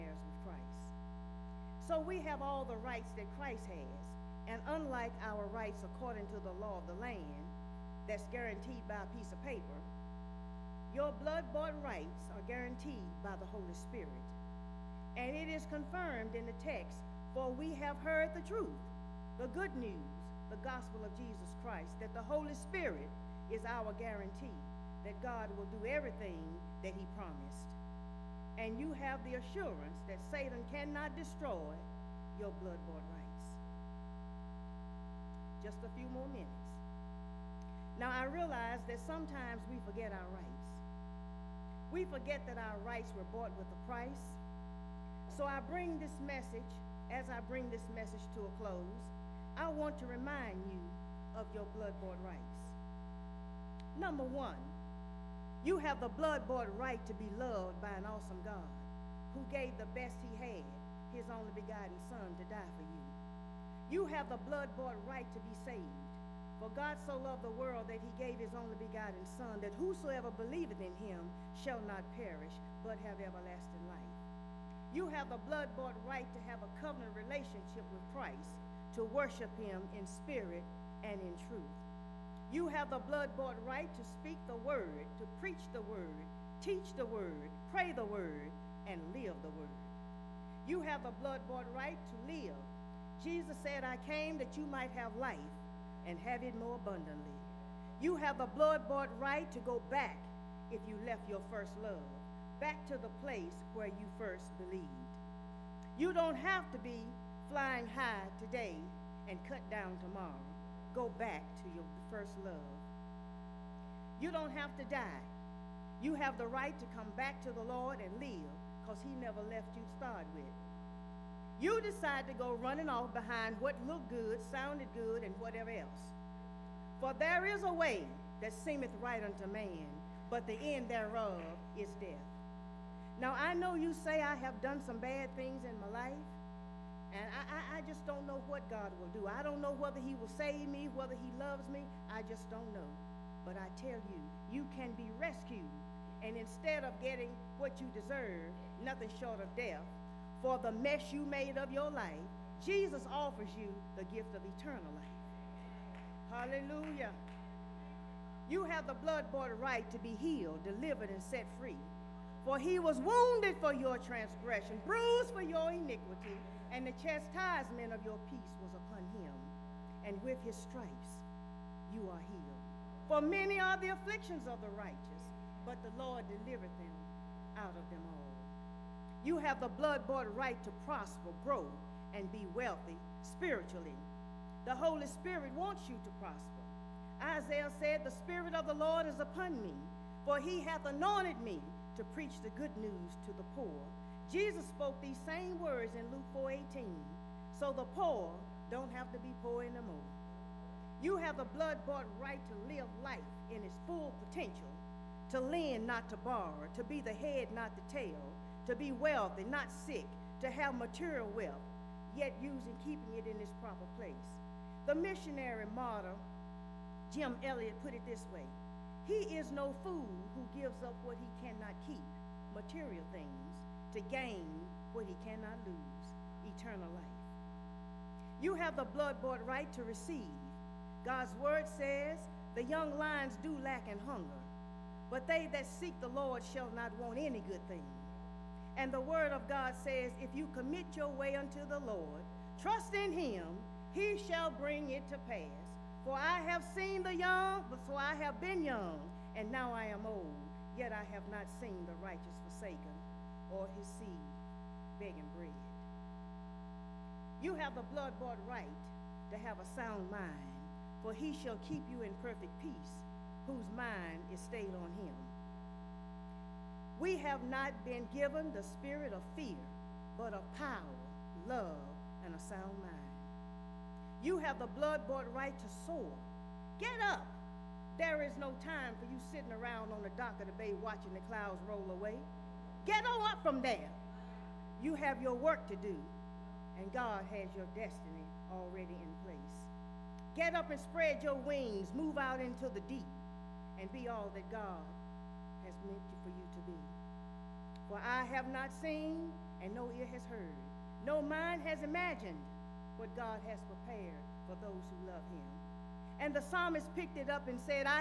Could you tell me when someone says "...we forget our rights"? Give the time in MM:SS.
00:39.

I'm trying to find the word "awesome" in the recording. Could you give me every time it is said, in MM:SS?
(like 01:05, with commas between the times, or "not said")
00:58.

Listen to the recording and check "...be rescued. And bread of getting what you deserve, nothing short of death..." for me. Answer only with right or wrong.
wrong.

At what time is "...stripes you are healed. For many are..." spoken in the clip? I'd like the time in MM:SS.
02:50.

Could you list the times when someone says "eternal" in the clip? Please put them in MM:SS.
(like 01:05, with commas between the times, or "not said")
02:34, 03:46.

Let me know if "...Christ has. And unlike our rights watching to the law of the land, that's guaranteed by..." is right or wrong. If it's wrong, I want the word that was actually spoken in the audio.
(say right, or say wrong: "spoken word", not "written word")
wrong: "according", not "watching".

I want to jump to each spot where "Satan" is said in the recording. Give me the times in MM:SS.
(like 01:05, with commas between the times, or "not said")
00:30.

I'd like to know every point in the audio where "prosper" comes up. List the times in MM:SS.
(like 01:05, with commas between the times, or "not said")
03:00, 03:06.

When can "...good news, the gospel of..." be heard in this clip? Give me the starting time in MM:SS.
00:19.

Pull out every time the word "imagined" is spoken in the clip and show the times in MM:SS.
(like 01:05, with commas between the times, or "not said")
05:01.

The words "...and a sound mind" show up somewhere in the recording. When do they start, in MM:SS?
04:32.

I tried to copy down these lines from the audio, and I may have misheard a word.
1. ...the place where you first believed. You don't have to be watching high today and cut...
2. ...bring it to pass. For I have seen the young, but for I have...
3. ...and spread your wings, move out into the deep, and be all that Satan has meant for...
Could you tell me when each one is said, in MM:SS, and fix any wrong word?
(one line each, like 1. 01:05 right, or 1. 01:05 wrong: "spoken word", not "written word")
1. 01:42 wrong: "flying", not "watching"
2. 04:04 right
3. 04:50 wrong: "God", not "Satan".